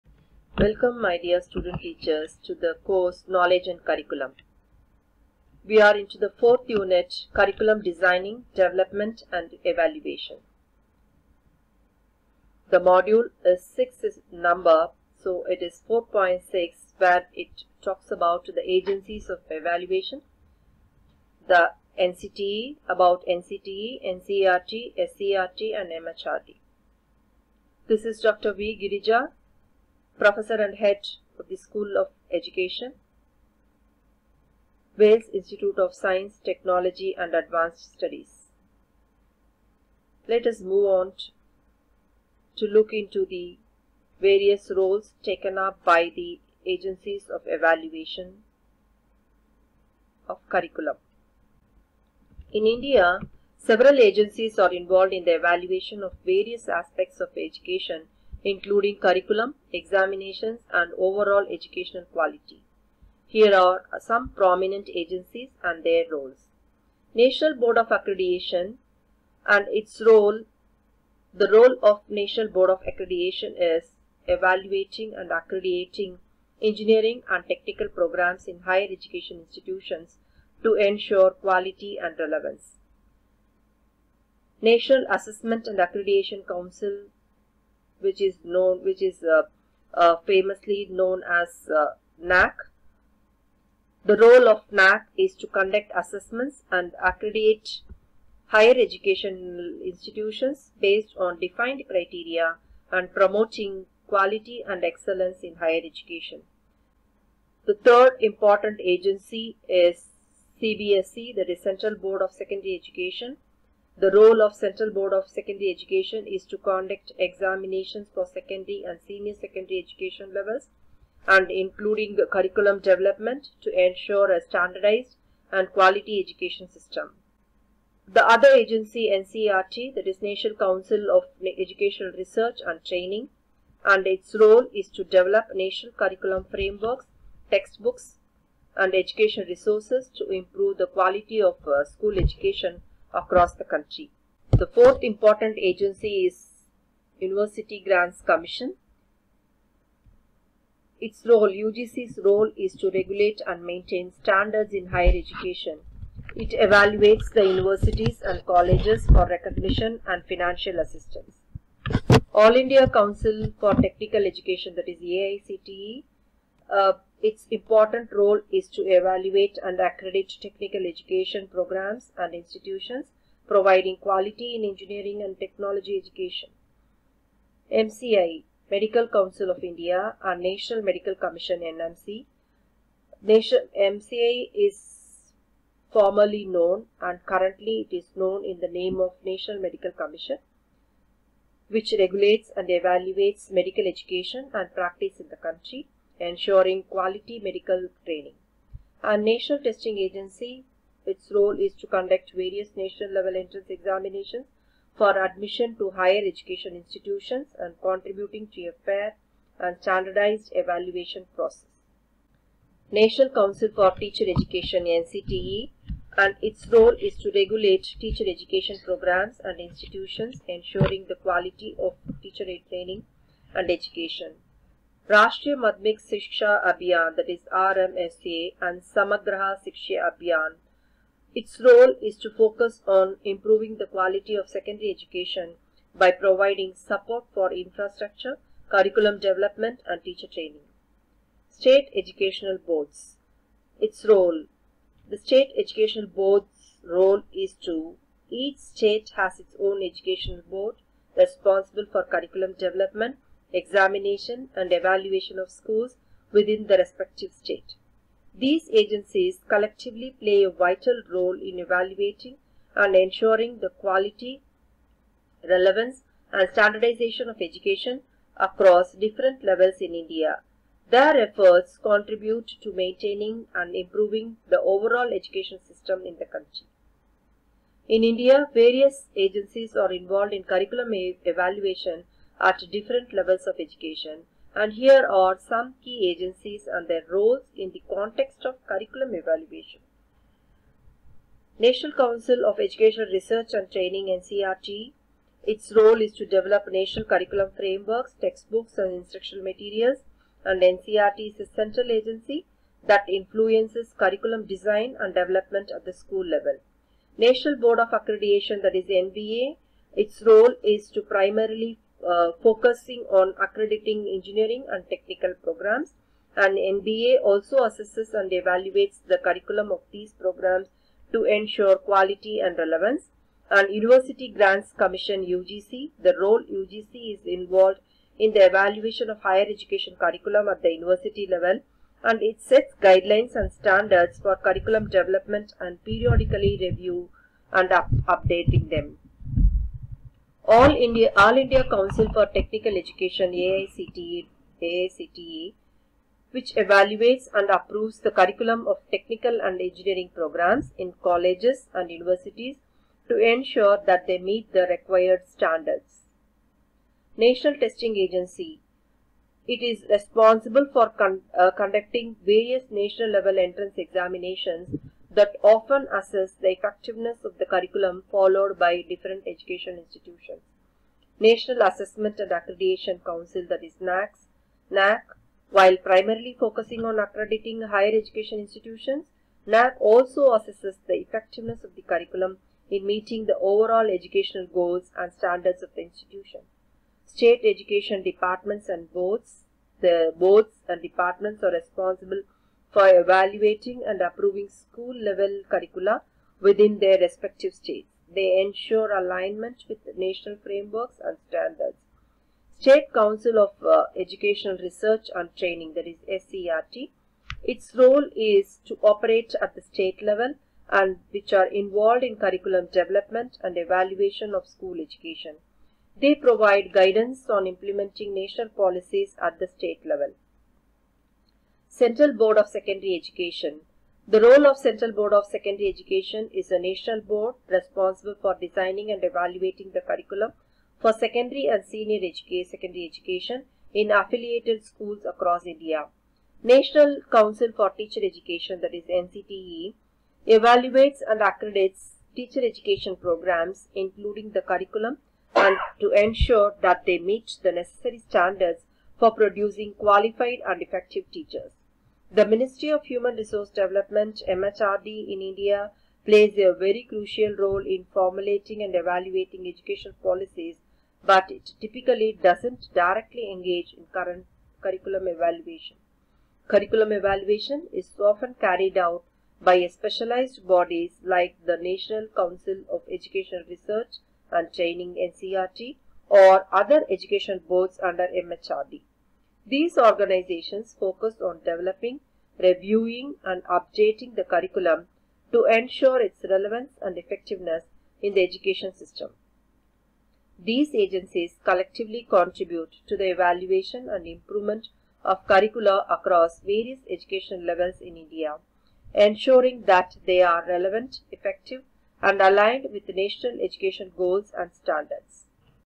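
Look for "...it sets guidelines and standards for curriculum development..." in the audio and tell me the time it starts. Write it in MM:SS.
05:32.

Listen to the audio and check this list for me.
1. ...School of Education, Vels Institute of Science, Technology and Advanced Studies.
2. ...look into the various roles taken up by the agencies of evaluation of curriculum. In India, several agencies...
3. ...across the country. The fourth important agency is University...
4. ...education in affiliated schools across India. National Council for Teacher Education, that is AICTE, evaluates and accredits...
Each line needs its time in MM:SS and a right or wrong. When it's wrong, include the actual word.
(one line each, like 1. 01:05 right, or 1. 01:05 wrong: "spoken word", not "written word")
1. 00:31 right
2. 00:42 right
3. 02:23 right
4. 07:12 wrong: "NCTE", not "AICTE".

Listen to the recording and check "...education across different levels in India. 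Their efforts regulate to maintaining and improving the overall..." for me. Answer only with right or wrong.
wrong.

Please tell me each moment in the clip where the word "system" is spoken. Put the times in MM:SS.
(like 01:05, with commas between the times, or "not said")
02:06, 04:35, 08:08.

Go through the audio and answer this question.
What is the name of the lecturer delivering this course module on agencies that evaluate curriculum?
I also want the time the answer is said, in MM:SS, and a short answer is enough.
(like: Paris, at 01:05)
Dr. V. Girija, at 00:28.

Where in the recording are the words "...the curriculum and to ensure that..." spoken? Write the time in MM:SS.
07:24.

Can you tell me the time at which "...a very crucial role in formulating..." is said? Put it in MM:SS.
07:36.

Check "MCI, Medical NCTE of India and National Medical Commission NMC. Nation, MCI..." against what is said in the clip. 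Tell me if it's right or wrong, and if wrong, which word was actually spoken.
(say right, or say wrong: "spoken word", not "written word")
wrong: "Council", not "NCTE".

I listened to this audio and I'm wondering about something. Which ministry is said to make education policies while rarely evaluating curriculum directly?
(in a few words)
Ministry of Human Resource Development.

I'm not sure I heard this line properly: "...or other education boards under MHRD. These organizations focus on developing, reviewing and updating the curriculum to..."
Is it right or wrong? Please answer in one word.
right.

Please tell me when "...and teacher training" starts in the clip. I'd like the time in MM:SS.
03:59.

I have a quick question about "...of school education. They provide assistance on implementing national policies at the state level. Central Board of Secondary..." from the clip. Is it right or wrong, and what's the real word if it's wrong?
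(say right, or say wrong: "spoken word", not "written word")
wrong: "guidance", not "assistance".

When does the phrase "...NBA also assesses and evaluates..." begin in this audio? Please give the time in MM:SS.
05:16.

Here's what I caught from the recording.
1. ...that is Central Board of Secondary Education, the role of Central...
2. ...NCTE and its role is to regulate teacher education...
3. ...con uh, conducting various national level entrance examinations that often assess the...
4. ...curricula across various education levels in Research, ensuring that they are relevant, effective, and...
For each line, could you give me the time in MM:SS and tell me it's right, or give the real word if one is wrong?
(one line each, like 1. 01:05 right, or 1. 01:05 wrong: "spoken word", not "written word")
1. 01:51 right
2. 03:34 right
3. 06:00 right
4. 08:15 wrong: "India", not "Research".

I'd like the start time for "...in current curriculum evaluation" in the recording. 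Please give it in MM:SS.
07:43.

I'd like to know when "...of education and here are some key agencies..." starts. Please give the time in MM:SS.
04:43.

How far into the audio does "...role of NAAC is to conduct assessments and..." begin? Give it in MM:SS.
01:34.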